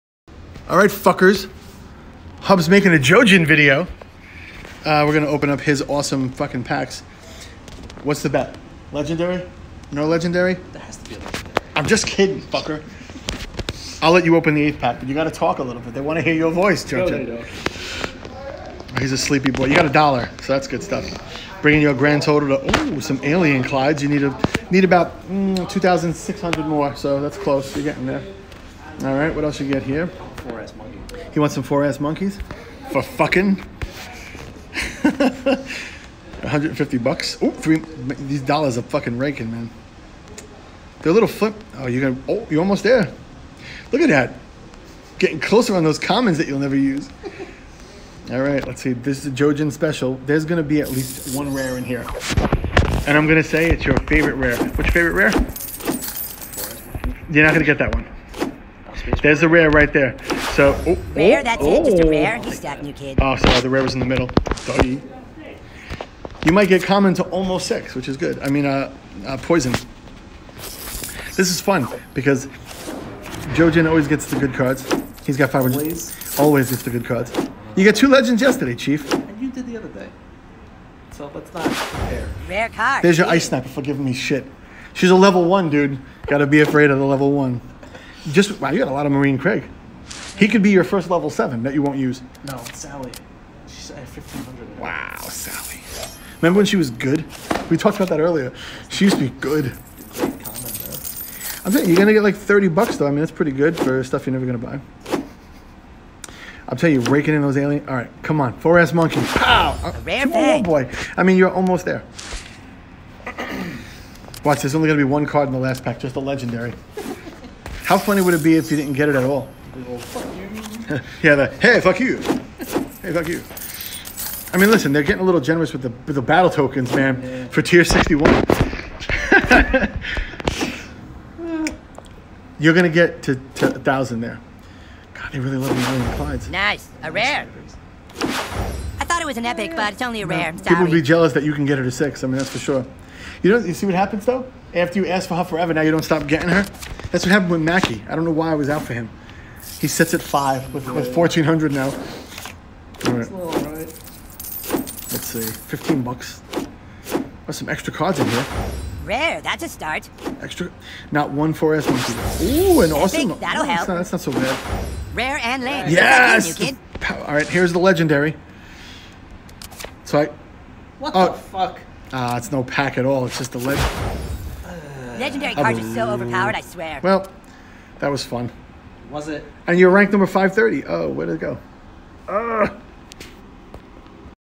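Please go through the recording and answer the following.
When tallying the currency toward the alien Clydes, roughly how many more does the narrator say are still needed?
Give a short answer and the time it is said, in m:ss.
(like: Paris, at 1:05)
2,600, at 0:25.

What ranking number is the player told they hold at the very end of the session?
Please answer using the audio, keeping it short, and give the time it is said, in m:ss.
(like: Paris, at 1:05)
530, at 3:00.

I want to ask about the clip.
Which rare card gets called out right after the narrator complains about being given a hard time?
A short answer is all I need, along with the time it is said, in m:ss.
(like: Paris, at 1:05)
Ice sniper, at 1:23.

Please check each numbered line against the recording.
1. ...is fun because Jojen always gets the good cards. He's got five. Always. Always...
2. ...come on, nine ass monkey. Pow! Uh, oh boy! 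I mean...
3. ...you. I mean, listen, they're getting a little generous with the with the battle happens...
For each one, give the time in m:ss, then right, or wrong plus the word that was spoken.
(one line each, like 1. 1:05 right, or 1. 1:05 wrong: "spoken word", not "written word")
1. 1:11 right
2. 1:48 wrong: "four", not "nine"
3. 2:03 wrong: "tokens", not "happens".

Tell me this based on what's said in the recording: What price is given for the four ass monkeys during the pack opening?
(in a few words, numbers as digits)
150 bucks.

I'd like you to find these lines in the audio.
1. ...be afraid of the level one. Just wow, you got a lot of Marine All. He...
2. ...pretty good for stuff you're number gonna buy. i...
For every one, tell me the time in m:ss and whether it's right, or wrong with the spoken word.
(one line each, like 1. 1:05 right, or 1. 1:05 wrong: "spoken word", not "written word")
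1. 1:26 wrong: "Craig", not "All"
2. 1:43 wrong: "never", not "number".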